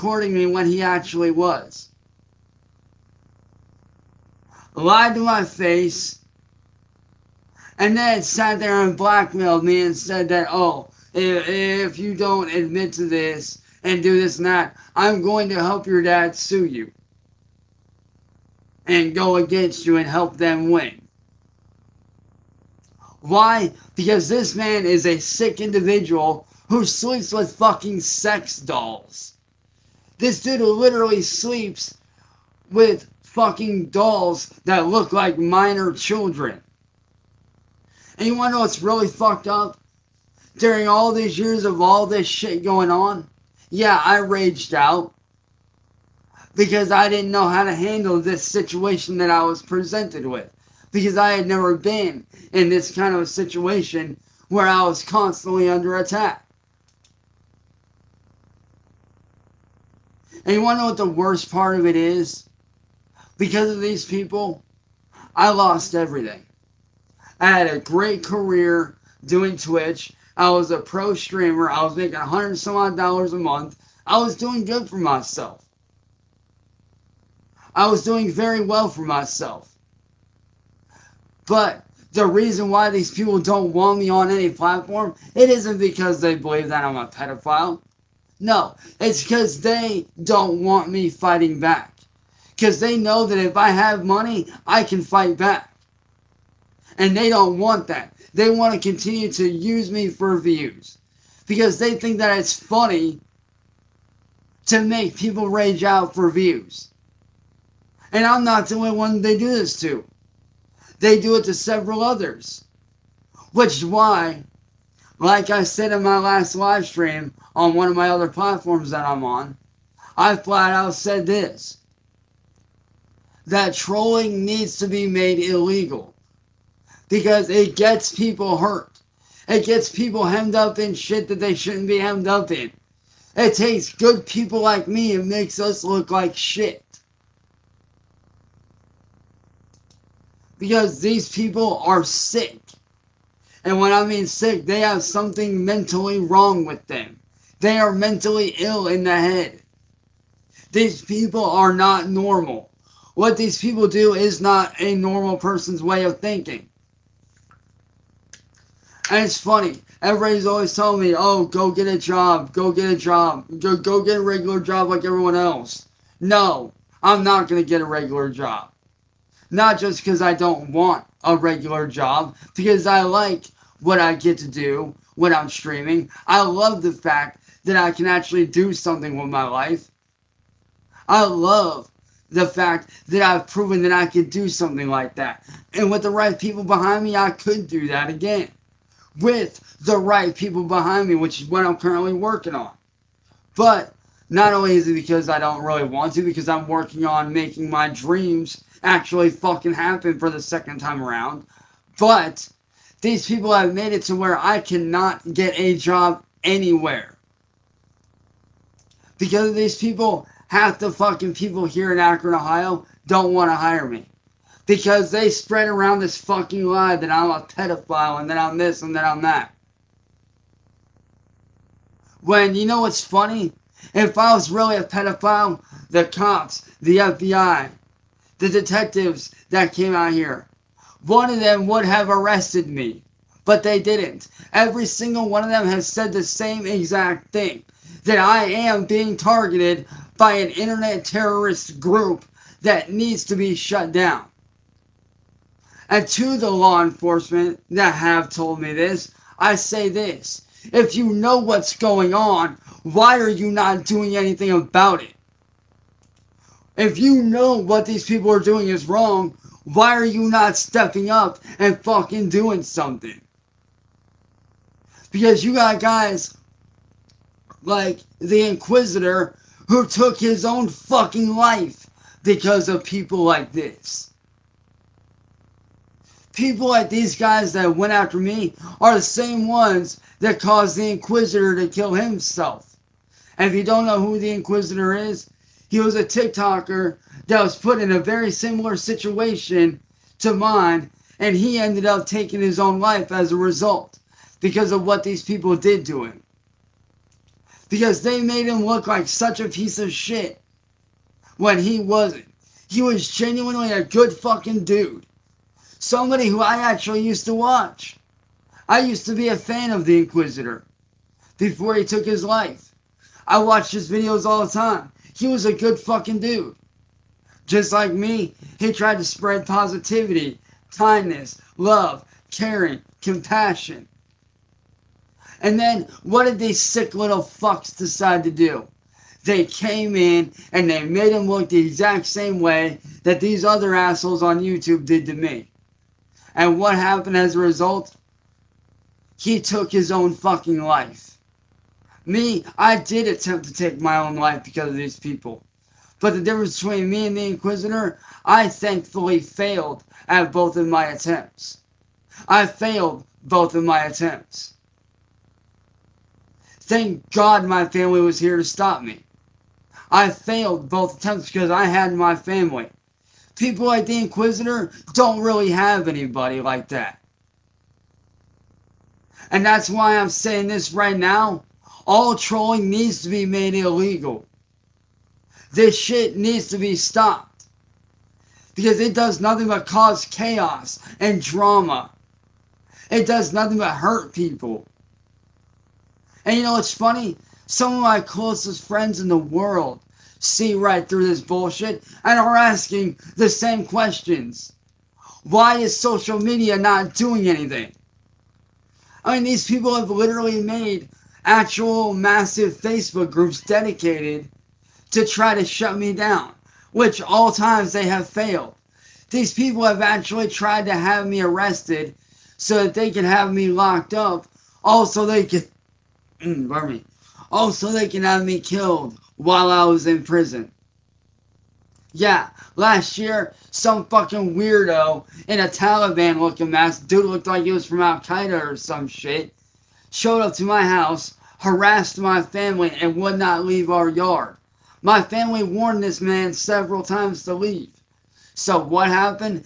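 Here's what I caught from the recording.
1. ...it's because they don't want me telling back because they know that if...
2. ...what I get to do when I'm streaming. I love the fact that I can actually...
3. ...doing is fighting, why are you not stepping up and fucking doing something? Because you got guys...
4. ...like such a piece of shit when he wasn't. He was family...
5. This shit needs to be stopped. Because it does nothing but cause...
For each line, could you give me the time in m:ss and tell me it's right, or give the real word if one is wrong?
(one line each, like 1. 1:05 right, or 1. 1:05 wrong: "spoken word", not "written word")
1. 1:28 wrong: "fighting", not "telling"
2. 2:53 right
3. 4:18 wrong: "wrong", not "fighting"
4. 4:58 wrong: "genuinely", not "family"
5. 6:15 right.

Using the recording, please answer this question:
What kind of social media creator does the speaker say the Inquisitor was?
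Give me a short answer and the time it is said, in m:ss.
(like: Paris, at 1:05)
TikToker, at 4:46.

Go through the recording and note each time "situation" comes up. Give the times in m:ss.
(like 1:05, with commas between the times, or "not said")
0:48, 0:53, 4:48.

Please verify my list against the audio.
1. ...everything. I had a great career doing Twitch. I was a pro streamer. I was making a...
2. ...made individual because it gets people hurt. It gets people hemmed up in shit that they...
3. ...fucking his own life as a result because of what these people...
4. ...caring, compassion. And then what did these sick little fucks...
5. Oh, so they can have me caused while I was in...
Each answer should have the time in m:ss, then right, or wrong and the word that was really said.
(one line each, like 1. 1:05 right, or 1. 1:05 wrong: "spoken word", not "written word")
1. 1:05 right
2. 2:05 wrong: "illegal", not "individual"
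3. 4:52 wrong: "taking", not "fucking"
4. 5:22 right
5. 6:57 wrong: "killed", not "caused".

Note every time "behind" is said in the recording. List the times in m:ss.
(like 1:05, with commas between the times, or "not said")
3:06, 3:10.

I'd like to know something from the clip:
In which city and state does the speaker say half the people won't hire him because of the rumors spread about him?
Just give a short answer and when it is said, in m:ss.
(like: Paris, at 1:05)
Akron, Ohio, at 3:31.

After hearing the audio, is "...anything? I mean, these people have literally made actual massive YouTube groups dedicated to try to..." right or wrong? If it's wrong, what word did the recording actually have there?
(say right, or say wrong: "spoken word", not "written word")
wrong: "Facebook", not "YouTube".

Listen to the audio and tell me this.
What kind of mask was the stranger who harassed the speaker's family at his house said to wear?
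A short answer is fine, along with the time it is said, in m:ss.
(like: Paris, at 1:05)
Taliban looking mask, at 7:05.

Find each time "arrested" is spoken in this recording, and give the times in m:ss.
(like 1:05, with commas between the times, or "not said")
3:52, 6:51.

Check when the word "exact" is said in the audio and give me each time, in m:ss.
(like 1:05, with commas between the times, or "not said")
3:56, 5:31.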